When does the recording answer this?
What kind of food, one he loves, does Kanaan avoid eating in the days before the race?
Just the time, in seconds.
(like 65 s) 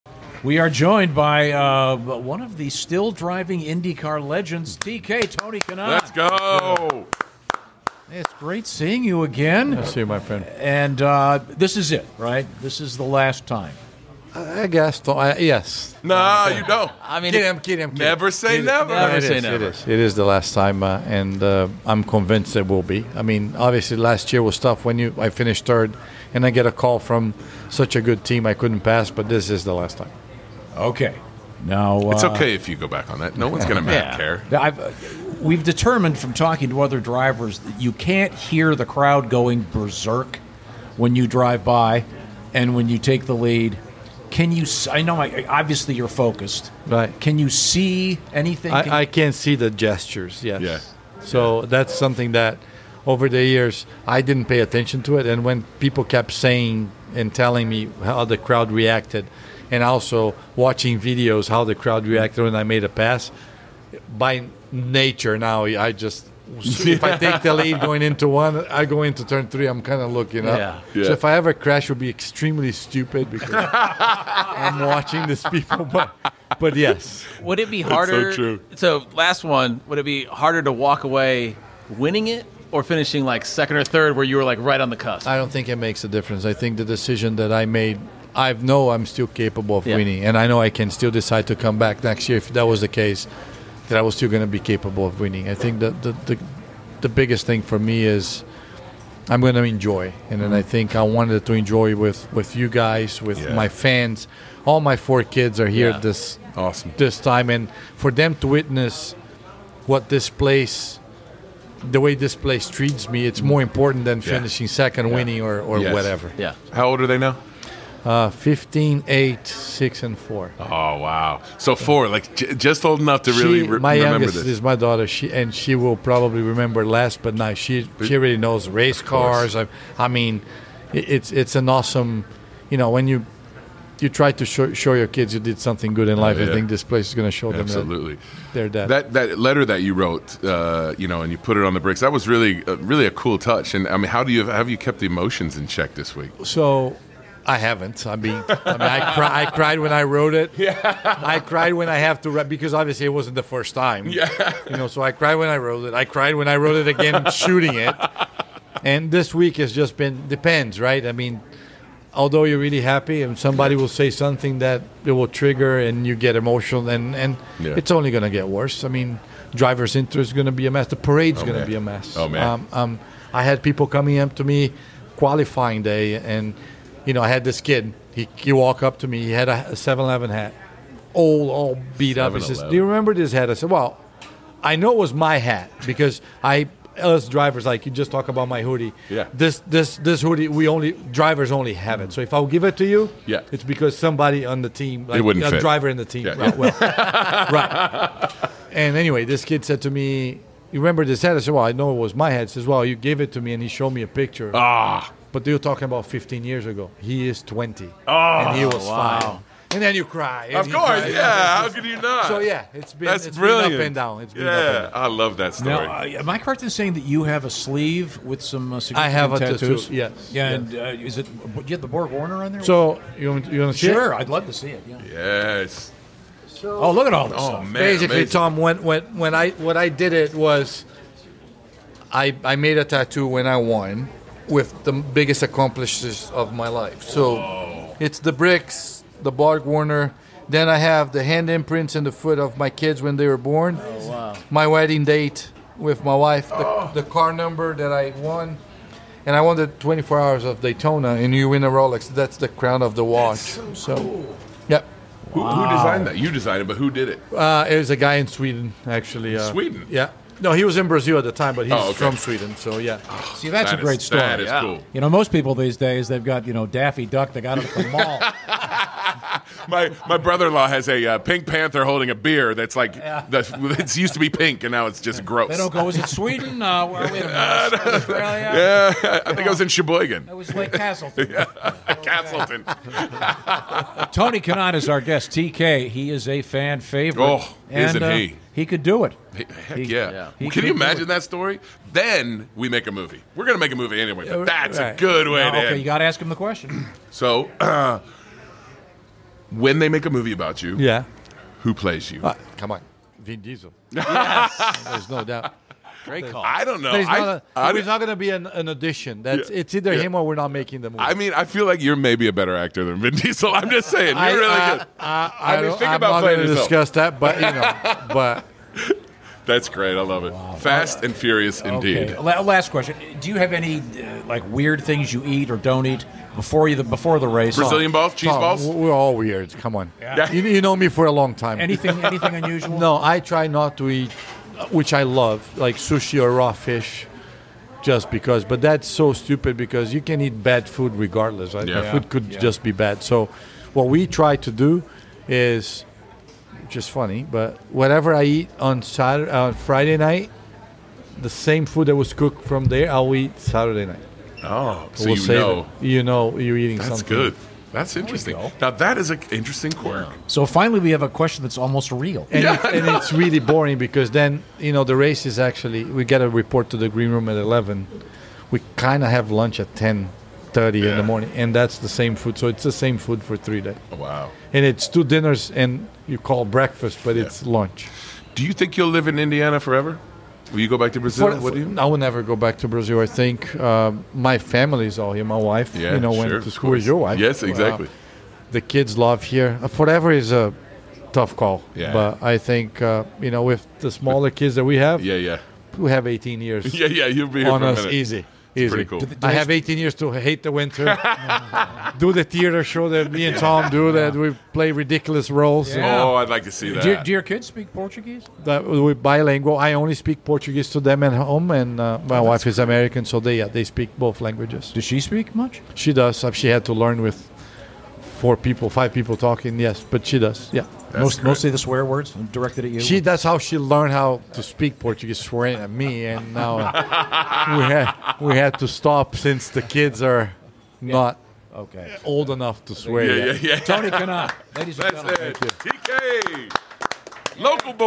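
335 s.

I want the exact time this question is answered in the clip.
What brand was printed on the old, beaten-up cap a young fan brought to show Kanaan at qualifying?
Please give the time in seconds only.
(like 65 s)
179 s.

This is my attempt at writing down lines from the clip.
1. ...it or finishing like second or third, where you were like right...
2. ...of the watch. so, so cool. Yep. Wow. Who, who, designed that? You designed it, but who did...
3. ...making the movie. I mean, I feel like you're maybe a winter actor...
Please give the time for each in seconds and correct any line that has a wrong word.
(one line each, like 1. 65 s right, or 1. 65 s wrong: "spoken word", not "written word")
1. 82 s right
2. 252 s right
3. 310 s wrong: "better", not "winter".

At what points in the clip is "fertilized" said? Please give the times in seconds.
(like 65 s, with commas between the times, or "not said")
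not said.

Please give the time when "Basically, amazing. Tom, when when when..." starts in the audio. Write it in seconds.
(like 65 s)
227 s.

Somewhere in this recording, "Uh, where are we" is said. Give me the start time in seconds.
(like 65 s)
276 s.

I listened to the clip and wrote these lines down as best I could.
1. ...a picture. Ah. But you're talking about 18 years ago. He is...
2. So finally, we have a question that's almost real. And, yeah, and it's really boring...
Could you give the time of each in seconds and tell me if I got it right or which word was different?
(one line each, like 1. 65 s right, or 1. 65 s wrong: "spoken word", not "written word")
1. 204 s wrong: "15", not "18"
2. 360 s right.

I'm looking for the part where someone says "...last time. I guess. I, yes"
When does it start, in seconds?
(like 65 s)
13 s.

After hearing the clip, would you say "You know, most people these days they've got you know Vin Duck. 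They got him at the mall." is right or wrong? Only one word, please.
wrong.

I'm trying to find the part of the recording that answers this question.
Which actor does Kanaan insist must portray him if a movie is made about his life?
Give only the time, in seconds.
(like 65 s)
303 s.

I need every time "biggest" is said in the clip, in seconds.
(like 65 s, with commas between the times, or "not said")
97 s, 234 s.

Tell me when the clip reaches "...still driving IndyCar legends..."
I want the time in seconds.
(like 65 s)
2 s.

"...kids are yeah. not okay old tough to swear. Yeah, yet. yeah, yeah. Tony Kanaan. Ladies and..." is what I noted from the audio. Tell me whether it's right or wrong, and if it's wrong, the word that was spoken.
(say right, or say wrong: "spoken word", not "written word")
wrong: "enough", not "tough".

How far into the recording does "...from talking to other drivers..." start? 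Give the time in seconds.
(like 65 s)
36 s.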